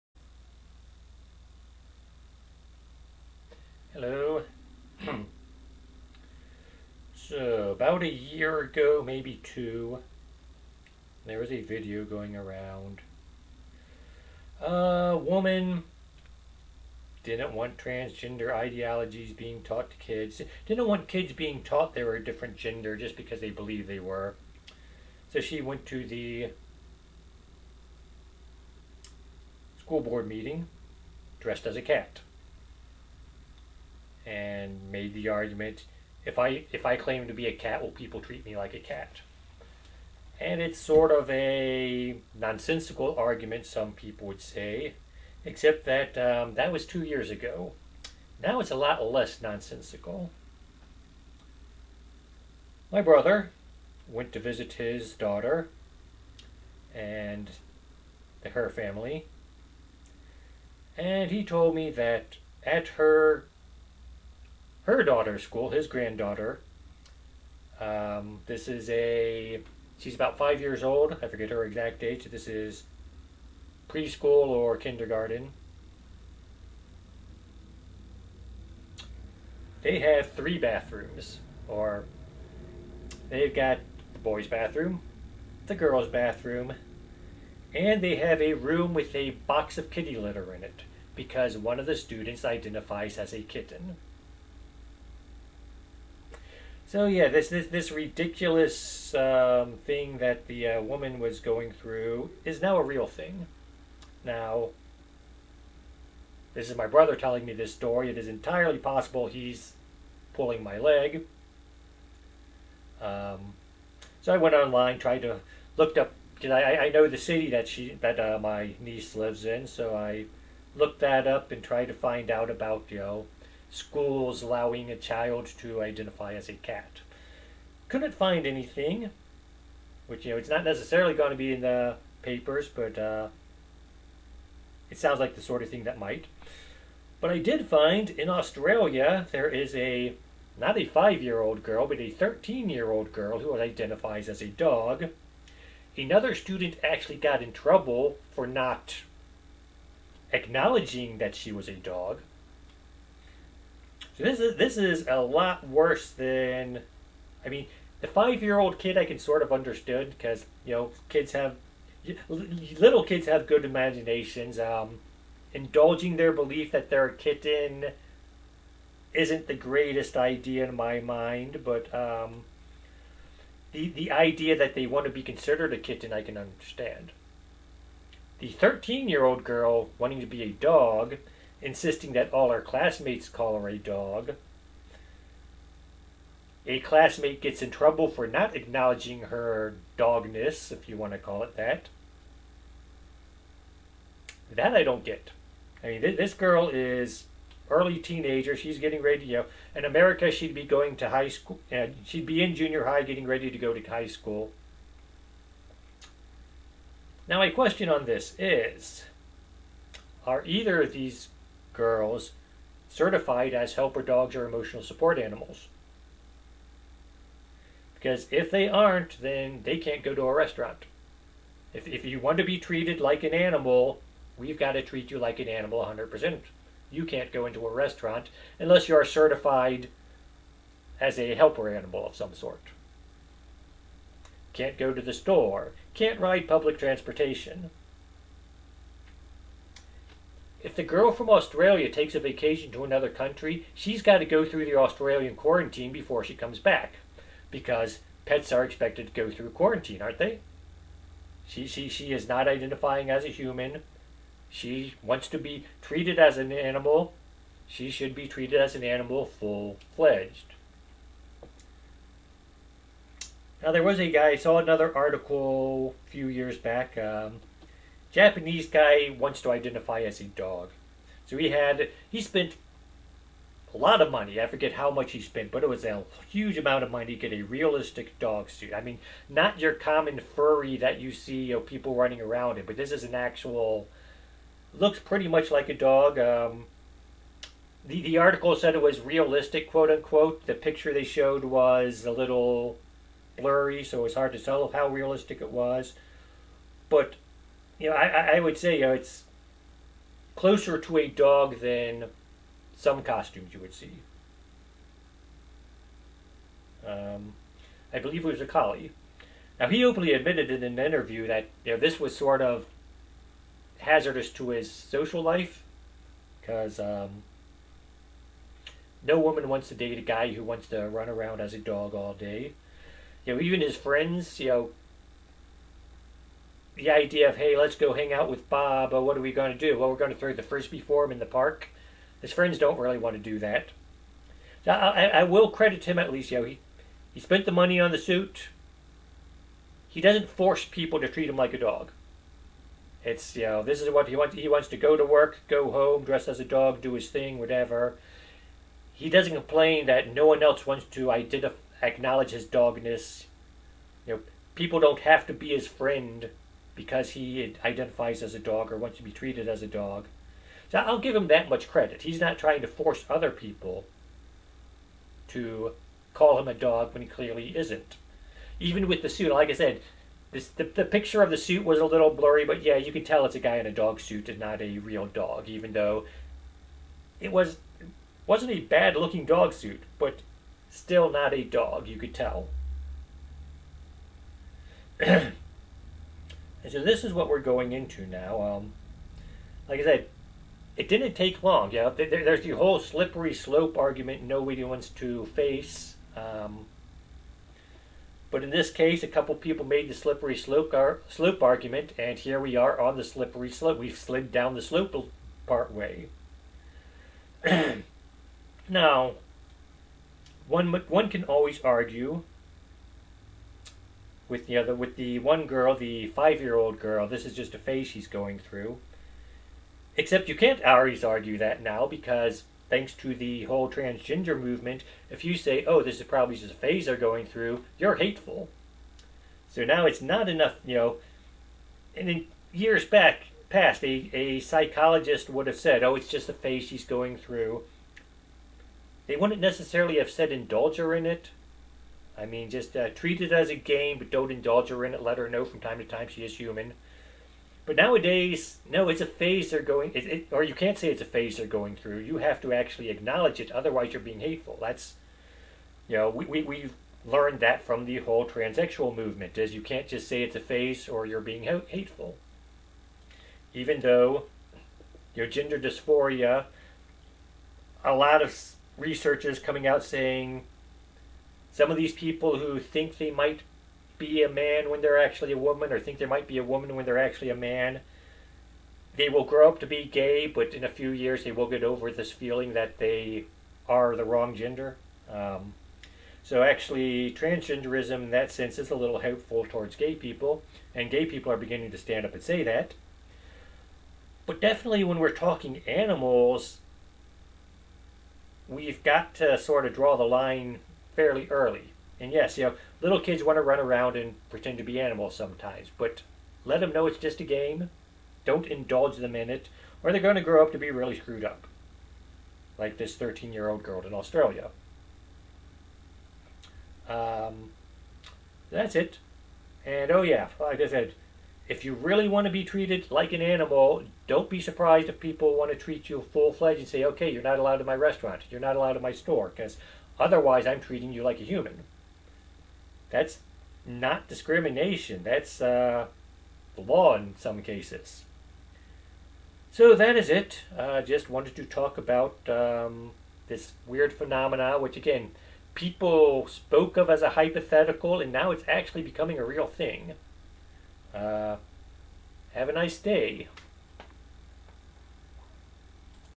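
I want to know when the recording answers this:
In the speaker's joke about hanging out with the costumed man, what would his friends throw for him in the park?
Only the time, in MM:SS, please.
05:30.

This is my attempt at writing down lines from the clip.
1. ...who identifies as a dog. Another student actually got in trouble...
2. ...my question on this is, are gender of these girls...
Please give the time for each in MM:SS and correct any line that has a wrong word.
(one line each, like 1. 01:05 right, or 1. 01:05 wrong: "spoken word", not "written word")
1. 02:23 right
2. 03:27 wrong: "either", not "gender".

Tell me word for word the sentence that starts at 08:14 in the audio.
But definitely, when we're talking animals, we've got to sort of draw the line fairly early.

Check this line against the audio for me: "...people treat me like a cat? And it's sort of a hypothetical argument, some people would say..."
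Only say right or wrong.
wrong.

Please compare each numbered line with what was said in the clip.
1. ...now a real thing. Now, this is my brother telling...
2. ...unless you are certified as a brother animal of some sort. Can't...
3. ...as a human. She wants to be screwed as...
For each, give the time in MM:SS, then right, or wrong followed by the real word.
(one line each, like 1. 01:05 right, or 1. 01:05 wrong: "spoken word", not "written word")
1. 01:42 right
2. 03:48 wrong: "helper", not "brother"
3. 04:13 wrong: "treated", not "screwed".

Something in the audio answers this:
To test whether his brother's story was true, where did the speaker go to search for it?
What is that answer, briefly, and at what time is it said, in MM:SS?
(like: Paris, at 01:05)
online, at 01:54.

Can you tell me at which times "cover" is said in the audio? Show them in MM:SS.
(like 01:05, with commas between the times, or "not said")
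not said.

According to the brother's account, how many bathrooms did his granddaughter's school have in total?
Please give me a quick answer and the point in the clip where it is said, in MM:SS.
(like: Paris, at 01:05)
3, at 01:20.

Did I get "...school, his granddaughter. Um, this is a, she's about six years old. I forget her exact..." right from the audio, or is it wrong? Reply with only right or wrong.
wrong.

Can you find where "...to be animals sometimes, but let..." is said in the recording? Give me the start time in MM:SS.
08:24.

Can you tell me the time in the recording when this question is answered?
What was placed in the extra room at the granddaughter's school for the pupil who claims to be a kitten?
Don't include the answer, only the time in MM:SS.
01:29.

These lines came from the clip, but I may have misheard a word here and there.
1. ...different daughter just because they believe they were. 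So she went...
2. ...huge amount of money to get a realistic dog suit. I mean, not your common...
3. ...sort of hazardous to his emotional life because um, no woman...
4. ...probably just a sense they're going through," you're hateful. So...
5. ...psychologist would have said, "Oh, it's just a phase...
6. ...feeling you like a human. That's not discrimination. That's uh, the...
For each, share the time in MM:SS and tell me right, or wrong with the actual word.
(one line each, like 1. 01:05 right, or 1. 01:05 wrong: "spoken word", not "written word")
1. 00:22 wrong: "gender", not "daughter"
2. 04:36 right
3. 05:12 wrong: "social", not "emotional"
4. 07:06 wrong: "phase", not "sense"
5. 07:14 right
6. 08:50 wrong: "treating", not "feeling".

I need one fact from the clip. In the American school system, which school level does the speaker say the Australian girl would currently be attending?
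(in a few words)
junior high.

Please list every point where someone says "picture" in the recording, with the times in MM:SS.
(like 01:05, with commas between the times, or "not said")
04:50, 06:10.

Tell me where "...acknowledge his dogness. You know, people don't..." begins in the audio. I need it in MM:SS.
05:51.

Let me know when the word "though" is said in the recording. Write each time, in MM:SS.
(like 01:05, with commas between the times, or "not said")
06:15, 07:43.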